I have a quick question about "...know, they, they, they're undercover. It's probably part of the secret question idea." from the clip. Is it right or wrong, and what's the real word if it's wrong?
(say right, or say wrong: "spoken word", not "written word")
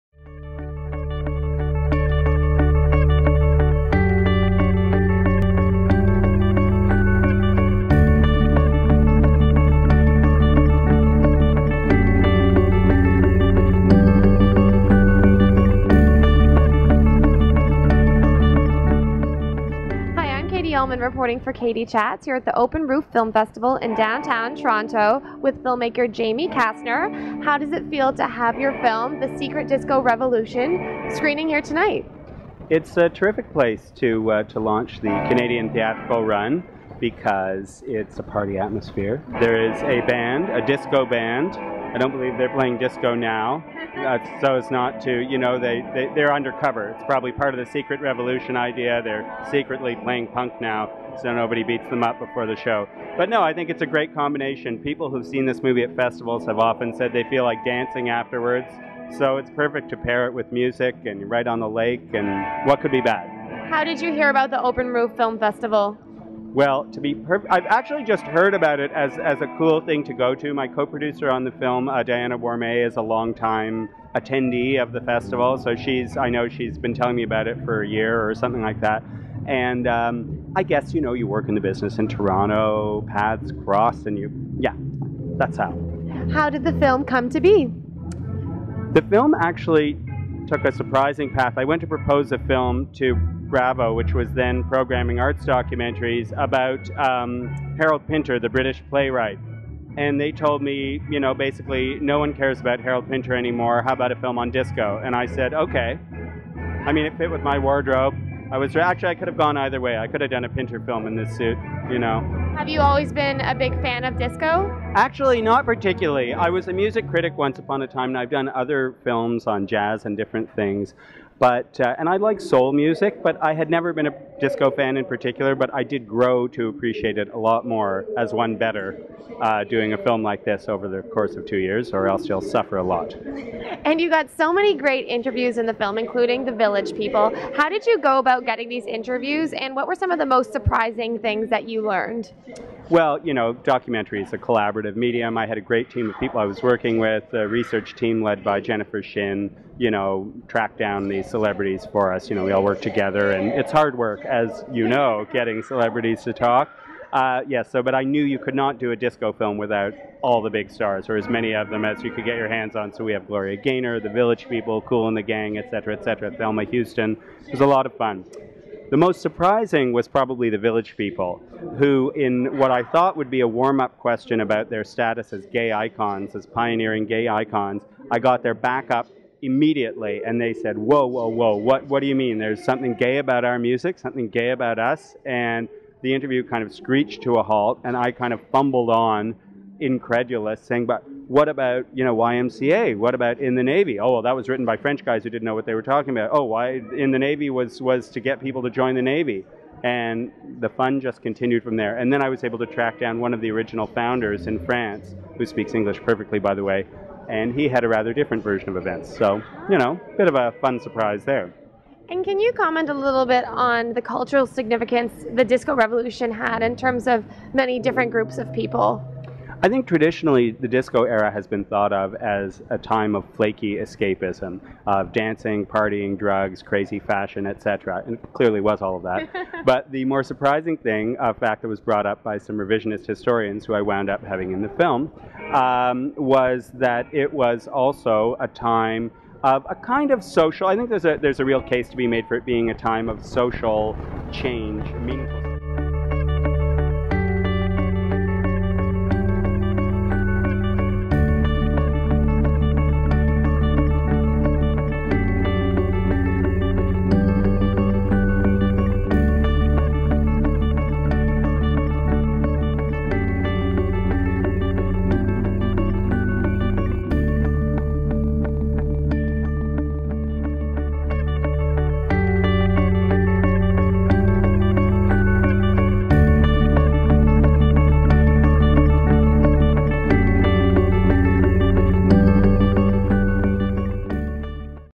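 wrong: "revolution", not "question".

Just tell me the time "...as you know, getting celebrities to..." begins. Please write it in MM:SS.
02:34.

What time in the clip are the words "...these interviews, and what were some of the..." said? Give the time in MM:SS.
02:18.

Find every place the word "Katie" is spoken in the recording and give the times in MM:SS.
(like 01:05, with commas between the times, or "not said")
00:21.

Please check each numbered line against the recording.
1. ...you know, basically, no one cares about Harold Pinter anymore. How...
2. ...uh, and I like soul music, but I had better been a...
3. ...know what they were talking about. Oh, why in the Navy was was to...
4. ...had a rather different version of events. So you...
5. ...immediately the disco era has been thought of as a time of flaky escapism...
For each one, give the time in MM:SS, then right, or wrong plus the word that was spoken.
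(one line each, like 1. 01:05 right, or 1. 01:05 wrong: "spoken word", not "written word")
1. 01:41 right
2. 02:01 wrong: "never", not "better"
3. 03:15 right
4. 03:27 right
5. 03:39 wrong: "traditionally", not "immediately".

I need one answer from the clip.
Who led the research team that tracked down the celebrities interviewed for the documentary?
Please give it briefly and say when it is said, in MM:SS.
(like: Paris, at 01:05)
Jennifer Shin, at 02:28.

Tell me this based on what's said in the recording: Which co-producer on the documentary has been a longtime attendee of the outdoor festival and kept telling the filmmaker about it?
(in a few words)
Diana Wormay.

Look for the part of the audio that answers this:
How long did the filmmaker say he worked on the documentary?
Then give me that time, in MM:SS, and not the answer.
02:11.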